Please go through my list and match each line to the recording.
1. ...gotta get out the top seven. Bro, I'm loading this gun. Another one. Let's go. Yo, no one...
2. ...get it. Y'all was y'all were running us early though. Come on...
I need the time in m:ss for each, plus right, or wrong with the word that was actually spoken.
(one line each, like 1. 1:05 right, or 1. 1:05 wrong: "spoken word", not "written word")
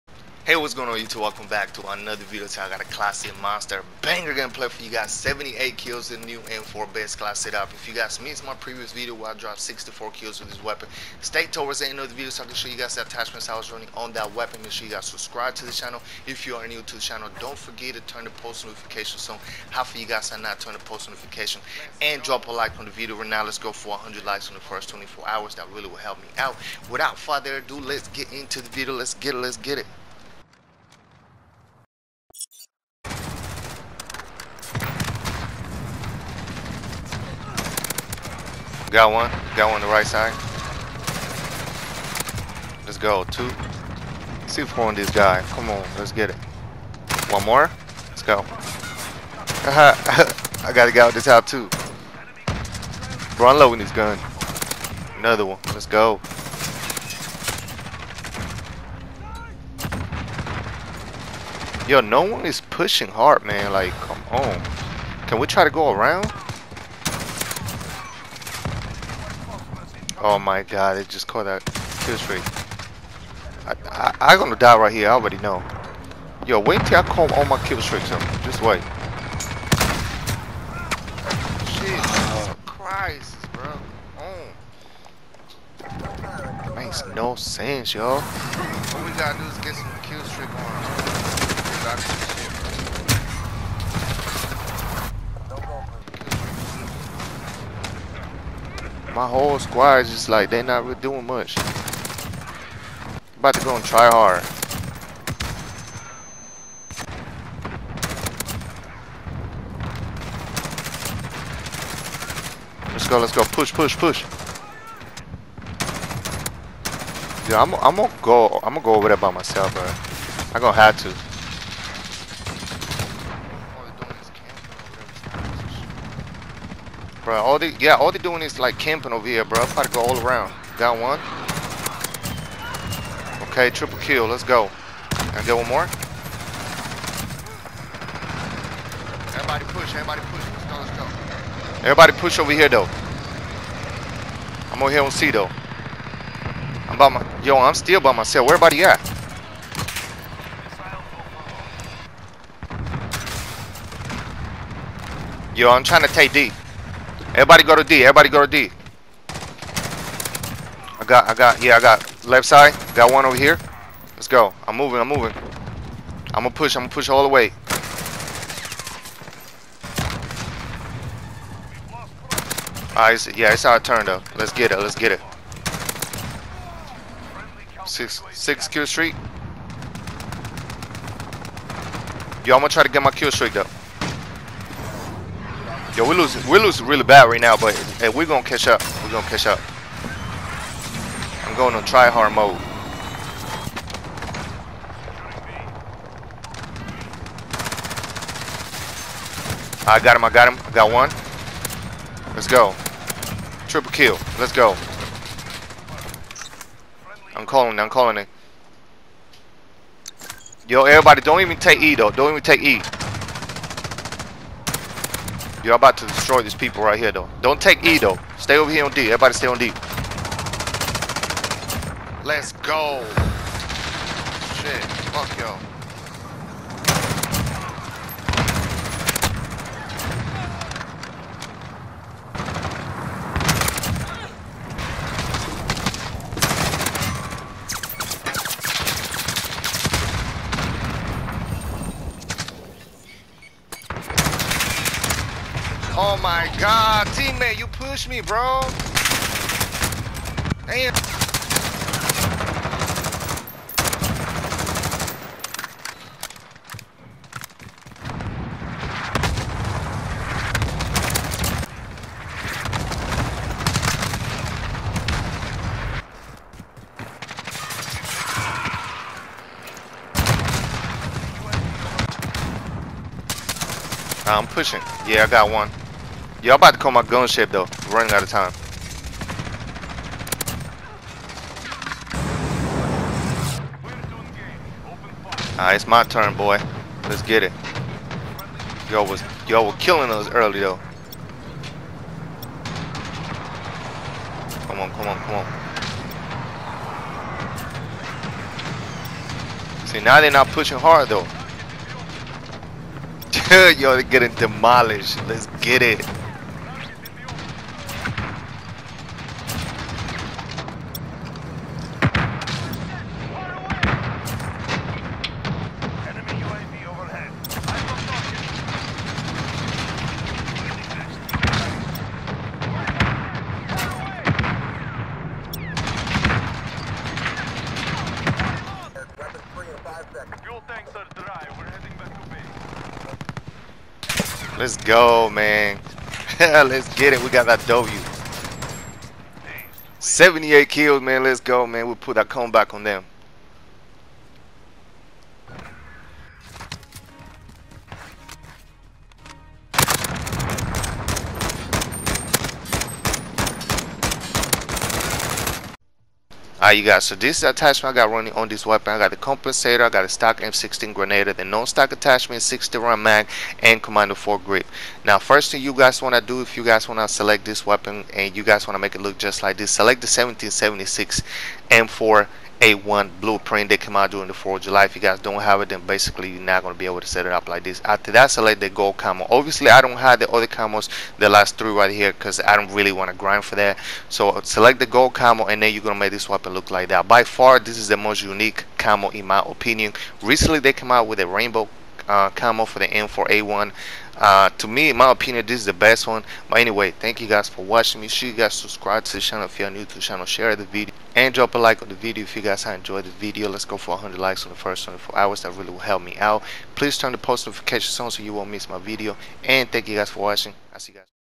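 1. 0:50 wrong: "two", not "seven"
2. 4:47 wrong: "killing", not "running".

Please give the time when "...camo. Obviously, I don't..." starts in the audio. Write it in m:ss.
6:18.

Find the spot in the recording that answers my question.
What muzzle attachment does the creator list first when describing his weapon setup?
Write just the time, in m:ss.
5:59.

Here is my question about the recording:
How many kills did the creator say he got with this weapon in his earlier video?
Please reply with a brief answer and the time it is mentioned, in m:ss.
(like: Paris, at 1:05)
64, at 0:09.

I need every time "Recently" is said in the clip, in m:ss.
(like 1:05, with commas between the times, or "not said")
6:30.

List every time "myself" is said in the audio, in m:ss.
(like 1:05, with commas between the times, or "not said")
1:59, 2:28.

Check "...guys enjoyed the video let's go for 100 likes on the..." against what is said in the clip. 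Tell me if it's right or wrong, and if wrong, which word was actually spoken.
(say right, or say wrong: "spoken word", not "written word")
right.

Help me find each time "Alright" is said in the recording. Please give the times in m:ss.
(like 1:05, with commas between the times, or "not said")
4:45, 5:56.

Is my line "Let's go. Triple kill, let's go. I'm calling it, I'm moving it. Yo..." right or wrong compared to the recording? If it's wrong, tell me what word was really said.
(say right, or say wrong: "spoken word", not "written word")
wrong: "calling", not "moving".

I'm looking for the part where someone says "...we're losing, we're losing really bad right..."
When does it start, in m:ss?
3:06.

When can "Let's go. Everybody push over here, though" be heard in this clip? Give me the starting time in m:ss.
2:20.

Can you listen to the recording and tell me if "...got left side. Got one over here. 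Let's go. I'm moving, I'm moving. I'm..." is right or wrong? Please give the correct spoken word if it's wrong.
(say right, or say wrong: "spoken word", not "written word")
right.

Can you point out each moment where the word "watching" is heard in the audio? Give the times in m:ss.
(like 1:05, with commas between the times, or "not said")
6:37, 6:50.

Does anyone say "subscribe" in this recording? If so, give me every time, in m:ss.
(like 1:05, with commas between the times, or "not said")
0:15, 6:38.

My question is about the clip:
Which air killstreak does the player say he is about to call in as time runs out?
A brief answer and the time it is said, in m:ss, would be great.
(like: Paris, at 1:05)
gunship, at 4:37.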